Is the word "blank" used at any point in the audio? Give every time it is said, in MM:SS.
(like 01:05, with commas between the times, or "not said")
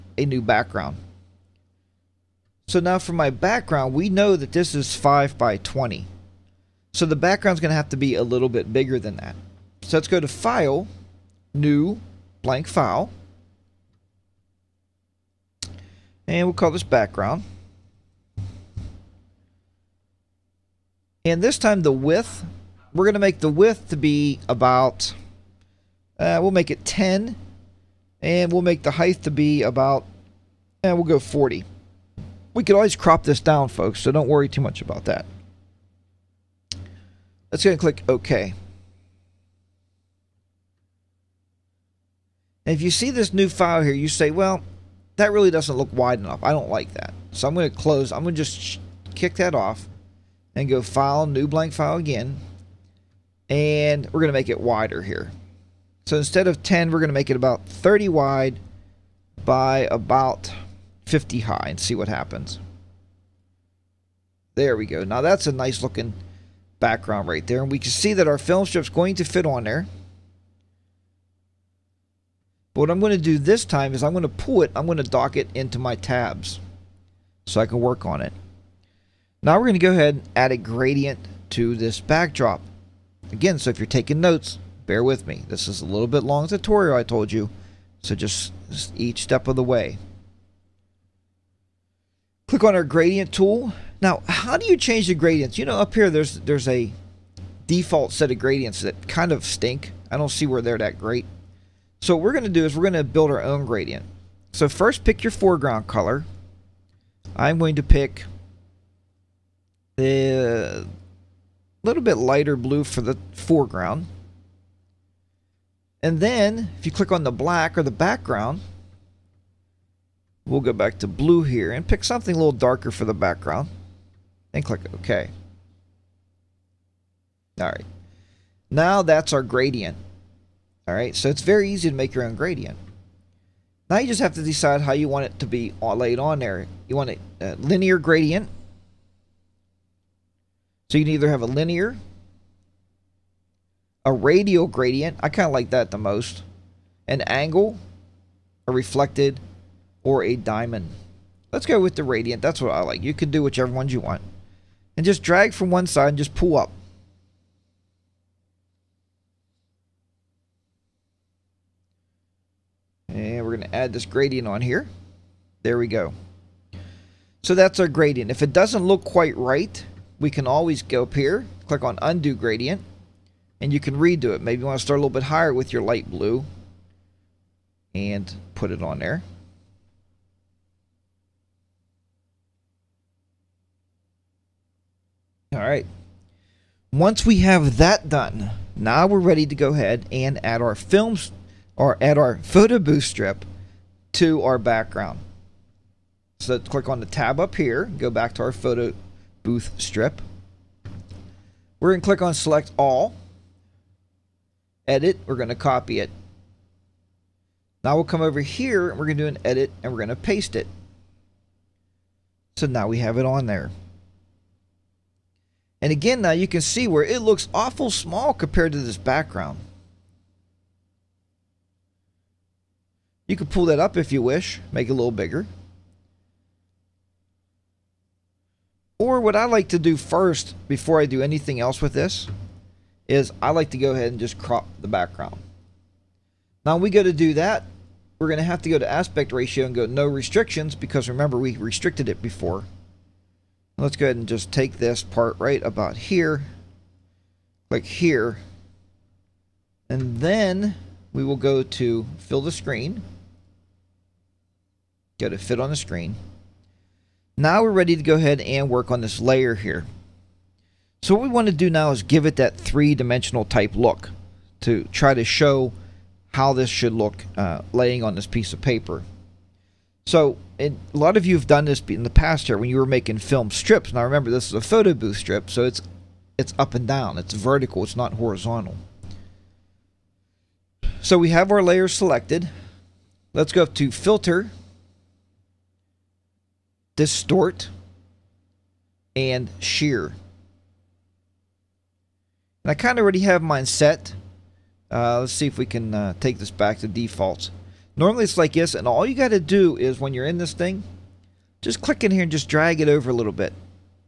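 00:12, 00:51.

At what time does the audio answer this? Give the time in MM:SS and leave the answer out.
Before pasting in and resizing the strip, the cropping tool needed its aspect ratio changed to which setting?
03:59.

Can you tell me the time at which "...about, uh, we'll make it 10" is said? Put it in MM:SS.
00:24.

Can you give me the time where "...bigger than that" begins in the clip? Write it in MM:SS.
00:08.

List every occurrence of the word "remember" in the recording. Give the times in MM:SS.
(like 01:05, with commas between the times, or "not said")
04:01, 04:34.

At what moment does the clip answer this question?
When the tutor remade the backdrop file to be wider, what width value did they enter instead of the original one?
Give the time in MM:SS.
00:57.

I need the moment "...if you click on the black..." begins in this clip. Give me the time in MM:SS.
01:56.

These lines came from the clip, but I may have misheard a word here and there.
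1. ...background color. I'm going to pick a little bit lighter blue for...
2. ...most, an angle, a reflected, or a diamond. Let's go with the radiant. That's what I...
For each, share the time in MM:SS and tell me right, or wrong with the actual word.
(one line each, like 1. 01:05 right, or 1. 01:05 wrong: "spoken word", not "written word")
1. 01:45 wrong: "foreground", not "background"
2. 02:25 right.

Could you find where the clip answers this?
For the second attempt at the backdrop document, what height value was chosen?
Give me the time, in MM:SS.
01:01.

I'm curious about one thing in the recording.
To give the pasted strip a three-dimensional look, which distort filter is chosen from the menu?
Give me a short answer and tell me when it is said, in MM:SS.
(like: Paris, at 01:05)
Shear, at 04:49.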